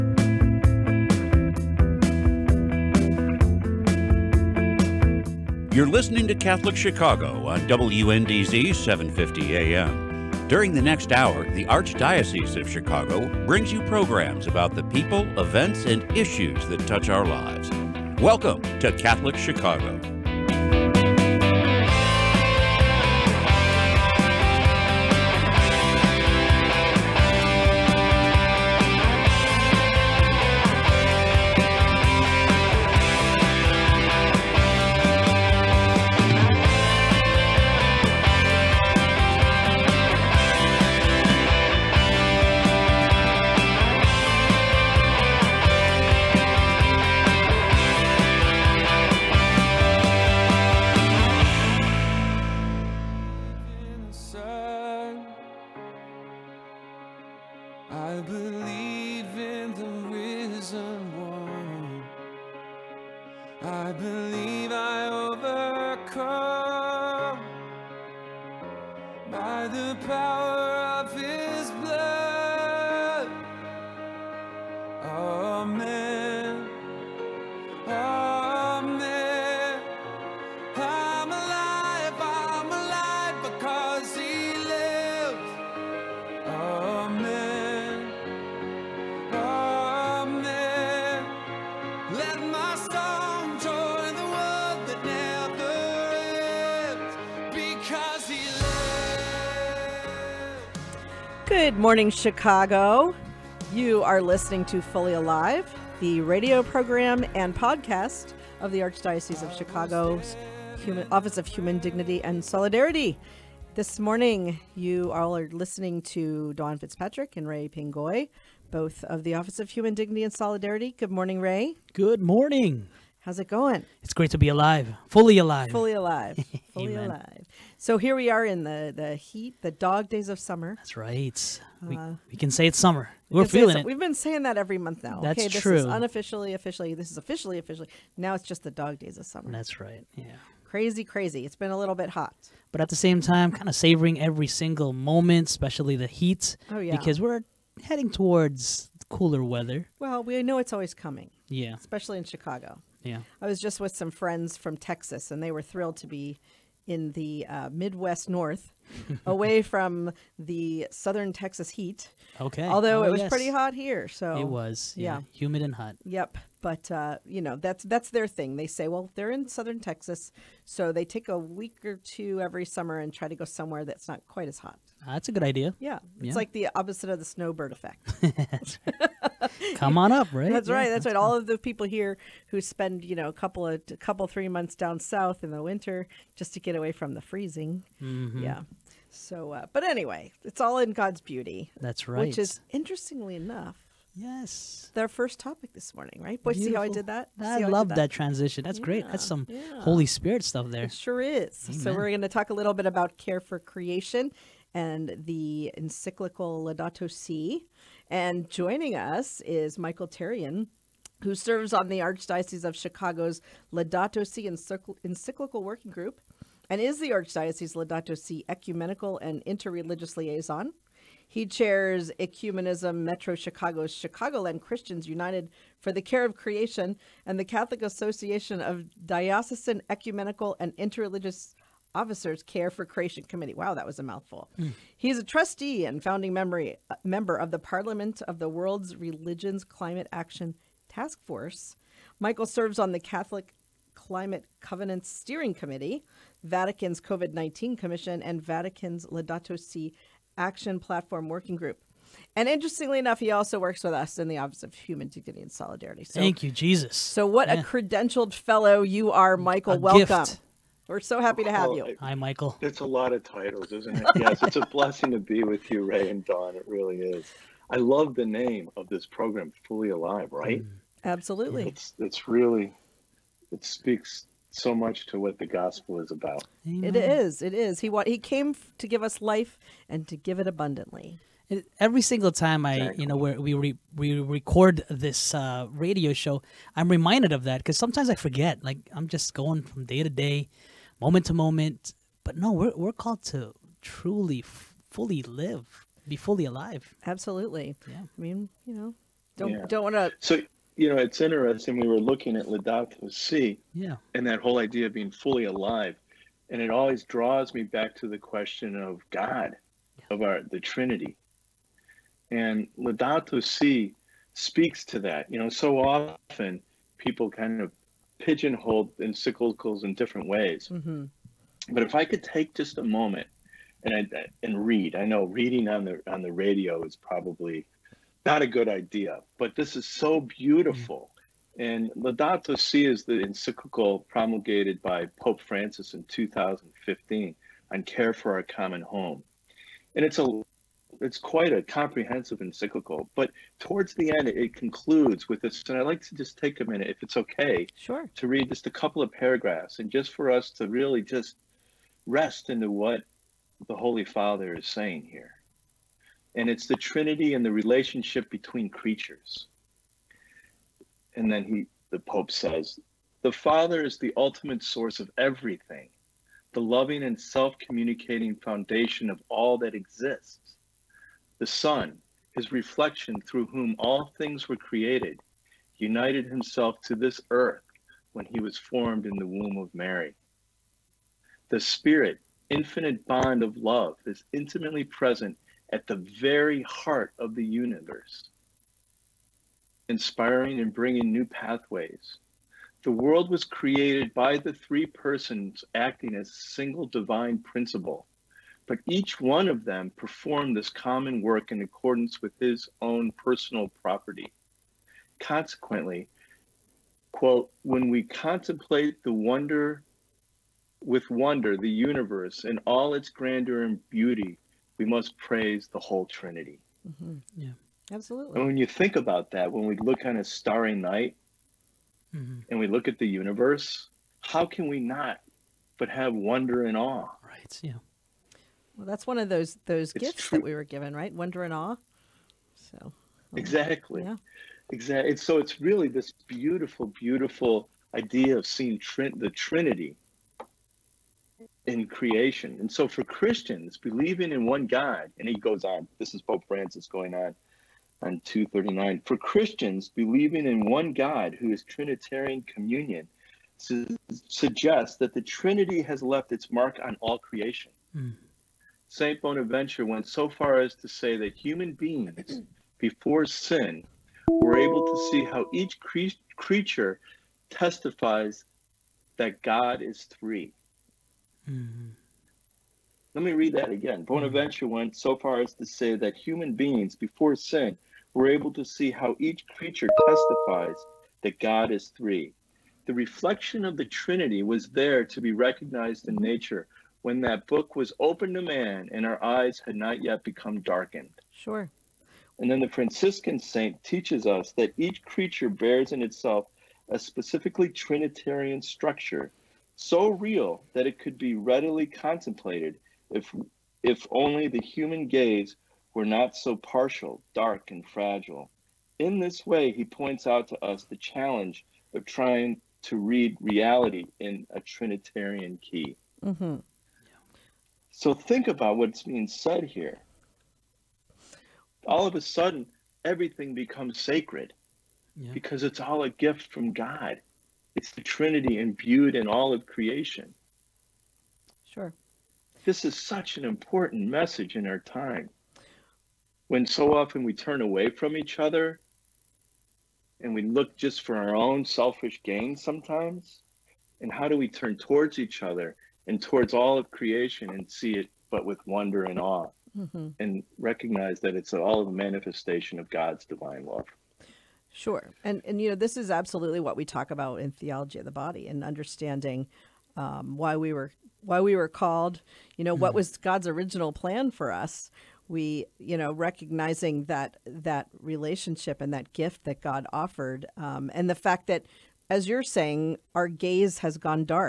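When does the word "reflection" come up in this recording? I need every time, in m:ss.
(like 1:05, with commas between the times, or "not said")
6:12, 8:02.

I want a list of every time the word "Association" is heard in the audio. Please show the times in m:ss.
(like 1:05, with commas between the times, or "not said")
3:47.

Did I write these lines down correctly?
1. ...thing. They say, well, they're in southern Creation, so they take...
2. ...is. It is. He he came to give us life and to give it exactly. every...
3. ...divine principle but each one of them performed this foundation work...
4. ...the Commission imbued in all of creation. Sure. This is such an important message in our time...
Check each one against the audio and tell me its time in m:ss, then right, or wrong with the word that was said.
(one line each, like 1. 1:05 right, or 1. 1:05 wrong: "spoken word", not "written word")
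1. 2:48 wrong: "Texas", not "Creation"
2. 4:36 wrong: "abundantly", not "exactly"
3. 6:36 wrong: "common", not "foundation"
4. 8:47 wrong: "Trinity", not "Commission".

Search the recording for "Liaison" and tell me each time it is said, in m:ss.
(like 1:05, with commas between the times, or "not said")
3:40.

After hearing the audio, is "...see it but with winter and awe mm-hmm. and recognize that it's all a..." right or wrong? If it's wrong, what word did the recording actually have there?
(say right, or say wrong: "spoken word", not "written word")
wrong: "wonder", not "winter".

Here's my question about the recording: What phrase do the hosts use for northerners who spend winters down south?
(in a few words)
snowbird effect.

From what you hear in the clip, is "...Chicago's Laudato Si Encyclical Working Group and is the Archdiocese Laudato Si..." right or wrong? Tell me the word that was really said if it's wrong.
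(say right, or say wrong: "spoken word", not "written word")
right.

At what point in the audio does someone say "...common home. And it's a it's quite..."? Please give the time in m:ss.
5:38.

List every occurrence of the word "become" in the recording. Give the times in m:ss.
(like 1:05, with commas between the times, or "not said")
8:10, 8:43.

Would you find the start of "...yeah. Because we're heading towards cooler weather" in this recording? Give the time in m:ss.
2:26.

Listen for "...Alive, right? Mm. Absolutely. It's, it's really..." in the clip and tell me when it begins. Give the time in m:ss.
4:29.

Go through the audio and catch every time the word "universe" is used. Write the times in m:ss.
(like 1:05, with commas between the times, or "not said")
6:27, 6:51, 7:03.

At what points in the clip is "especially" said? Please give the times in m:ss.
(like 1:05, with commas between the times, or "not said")
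2:25, 2:31.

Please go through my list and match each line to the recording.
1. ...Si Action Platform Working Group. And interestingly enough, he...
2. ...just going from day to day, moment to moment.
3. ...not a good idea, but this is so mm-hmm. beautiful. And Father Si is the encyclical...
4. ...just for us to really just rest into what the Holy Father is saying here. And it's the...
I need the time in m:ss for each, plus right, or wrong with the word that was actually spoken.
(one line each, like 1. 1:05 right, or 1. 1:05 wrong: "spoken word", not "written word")
1. 4:09 right
2. 4:49 right
3. 5:28 wrong: "Laudato", not "Father"
4. 5:49 right.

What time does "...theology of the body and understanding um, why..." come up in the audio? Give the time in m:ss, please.
9:17.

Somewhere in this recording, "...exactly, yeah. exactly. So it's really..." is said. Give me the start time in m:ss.
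7:13.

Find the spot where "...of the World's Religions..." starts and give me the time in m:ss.
3:58.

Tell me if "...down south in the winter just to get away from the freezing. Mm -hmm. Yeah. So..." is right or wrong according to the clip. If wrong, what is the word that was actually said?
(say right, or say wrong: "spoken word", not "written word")
right.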